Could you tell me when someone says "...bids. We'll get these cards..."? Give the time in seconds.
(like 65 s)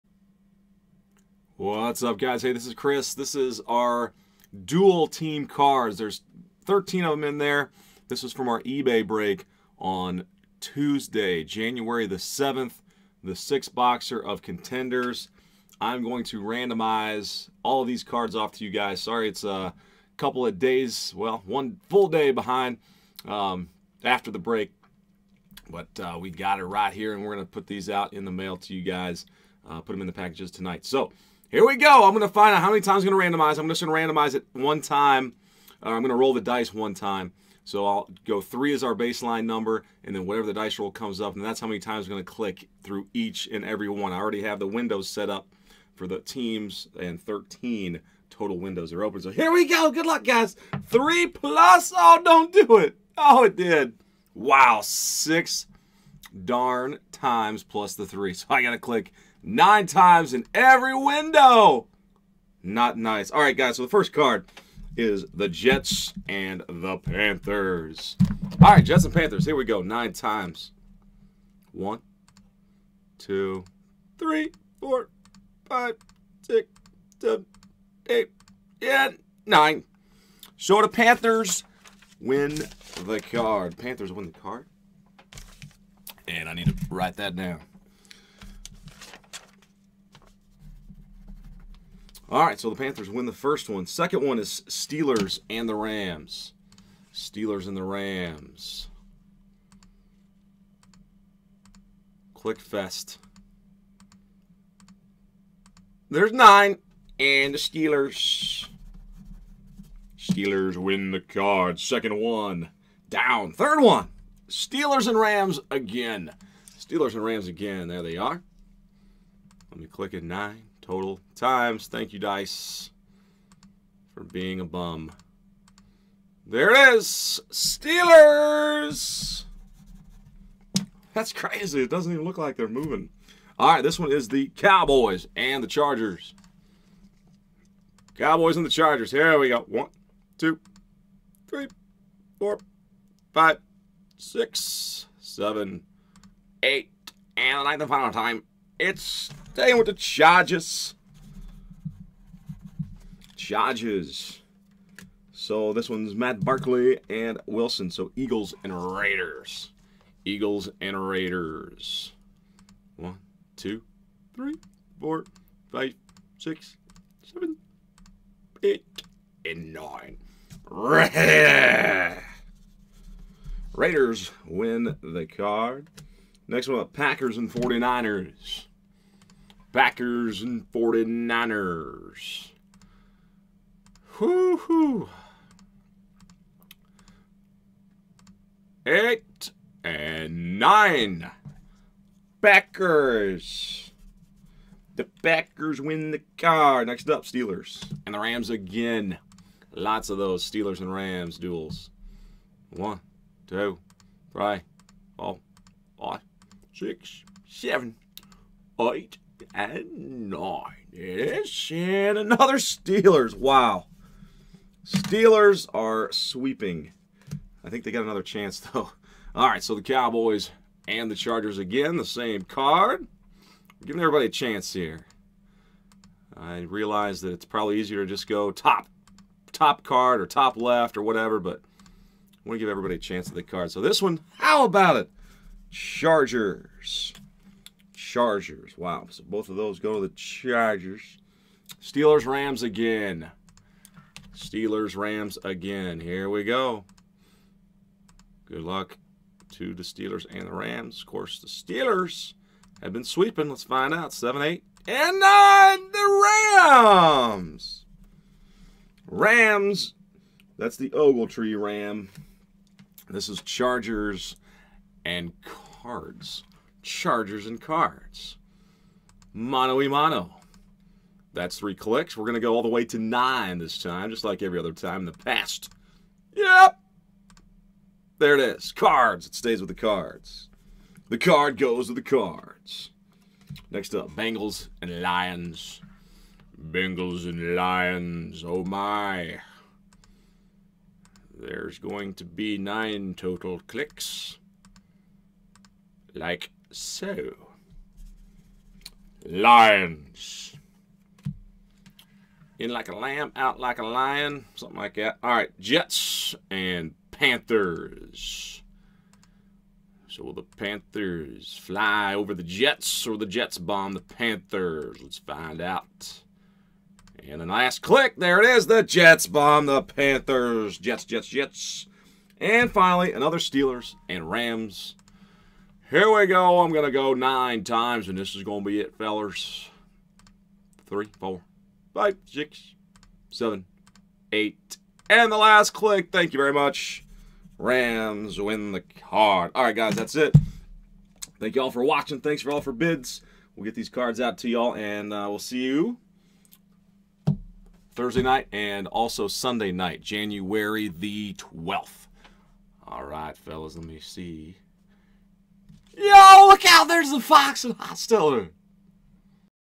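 342 s.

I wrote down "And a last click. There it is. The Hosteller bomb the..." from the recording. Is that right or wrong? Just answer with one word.
wrong.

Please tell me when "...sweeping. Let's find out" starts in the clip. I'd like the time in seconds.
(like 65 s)
253 s.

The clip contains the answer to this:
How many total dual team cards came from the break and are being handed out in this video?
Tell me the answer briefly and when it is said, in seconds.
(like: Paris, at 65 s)
13, at 6 s.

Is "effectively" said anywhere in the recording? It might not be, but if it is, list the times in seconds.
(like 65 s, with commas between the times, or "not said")
not said.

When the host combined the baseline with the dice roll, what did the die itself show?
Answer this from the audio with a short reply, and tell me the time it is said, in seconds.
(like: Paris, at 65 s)
6, at 54 s.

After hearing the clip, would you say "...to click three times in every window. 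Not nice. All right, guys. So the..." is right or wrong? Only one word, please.
wrong.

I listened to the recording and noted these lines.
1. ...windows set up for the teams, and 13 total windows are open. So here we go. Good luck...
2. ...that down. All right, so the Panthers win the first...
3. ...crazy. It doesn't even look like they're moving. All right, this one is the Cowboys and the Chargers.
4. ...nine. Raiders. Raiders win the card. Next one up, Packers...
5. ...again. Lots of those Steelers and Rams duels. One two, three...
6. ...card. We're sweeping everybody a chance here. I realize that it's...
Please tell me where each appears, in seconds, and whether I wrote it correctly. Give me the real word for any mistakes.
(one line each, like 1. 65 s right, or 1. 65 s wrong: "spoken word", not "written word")
1. 44 s right
2. 87 s right
3. 131 s right
4. 169 s right
5. 198 s right
6. 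222 s wrong: "giving", not "sweeping".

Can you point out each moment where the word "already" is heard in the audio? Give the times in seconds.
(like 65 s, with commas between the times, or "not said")
44 s.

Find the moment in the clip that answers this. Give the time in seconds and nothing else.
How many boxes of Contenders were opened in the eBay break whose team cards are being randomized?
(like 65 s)
13 s.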